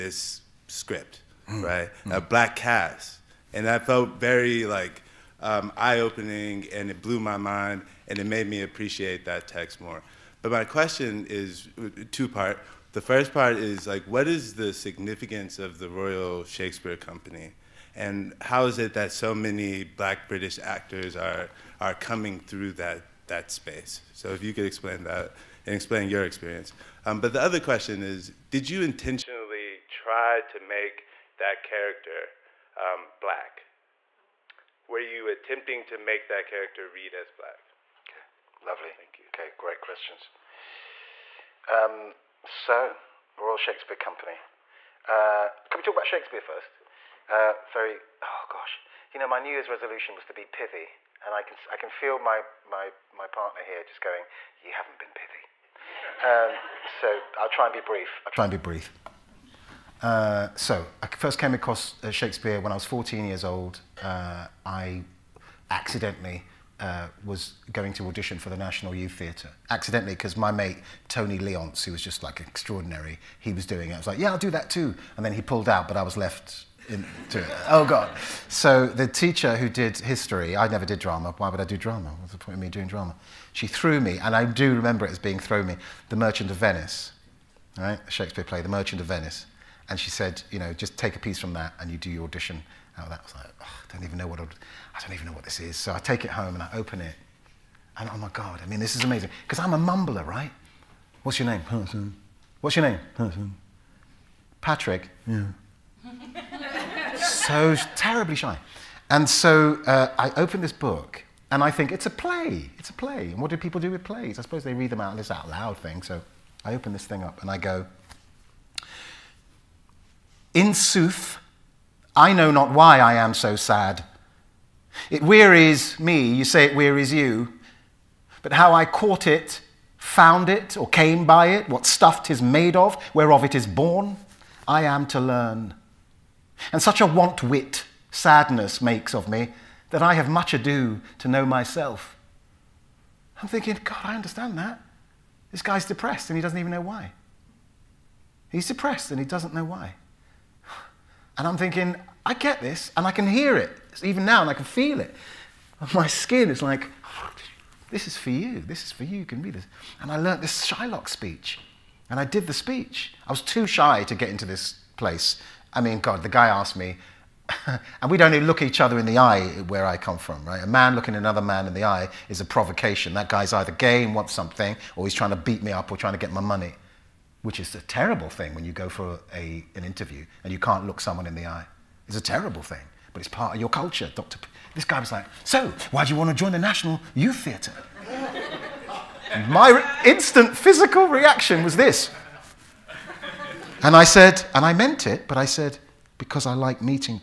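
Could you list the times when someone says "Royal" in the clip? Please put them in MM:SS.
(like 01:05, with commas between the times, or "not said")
00:15, 00:43.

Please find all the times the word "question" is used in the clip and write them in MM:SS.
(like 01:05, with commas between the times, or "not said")
00:10, 00:27, 00:39.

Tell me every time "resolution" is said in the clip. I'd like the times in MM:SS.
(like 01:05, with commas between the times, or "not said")
00:49.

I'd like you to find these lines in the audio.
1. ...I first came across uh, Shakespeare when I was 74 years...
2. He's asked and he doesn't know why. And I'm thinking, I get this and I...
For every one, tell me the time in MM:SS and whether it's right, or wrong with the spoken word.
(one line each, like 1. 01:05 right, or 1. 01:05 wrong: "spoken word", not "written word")
1. 01:01 wrong: "14", not "74"
2. 02:28 wrong: "depressed", not "asked".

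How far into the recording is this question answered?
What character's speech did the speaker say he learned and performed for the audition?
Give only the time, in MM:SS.
02:40.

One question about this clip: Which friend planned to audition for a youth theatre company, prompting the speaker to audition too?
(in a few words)
Tony Leonce.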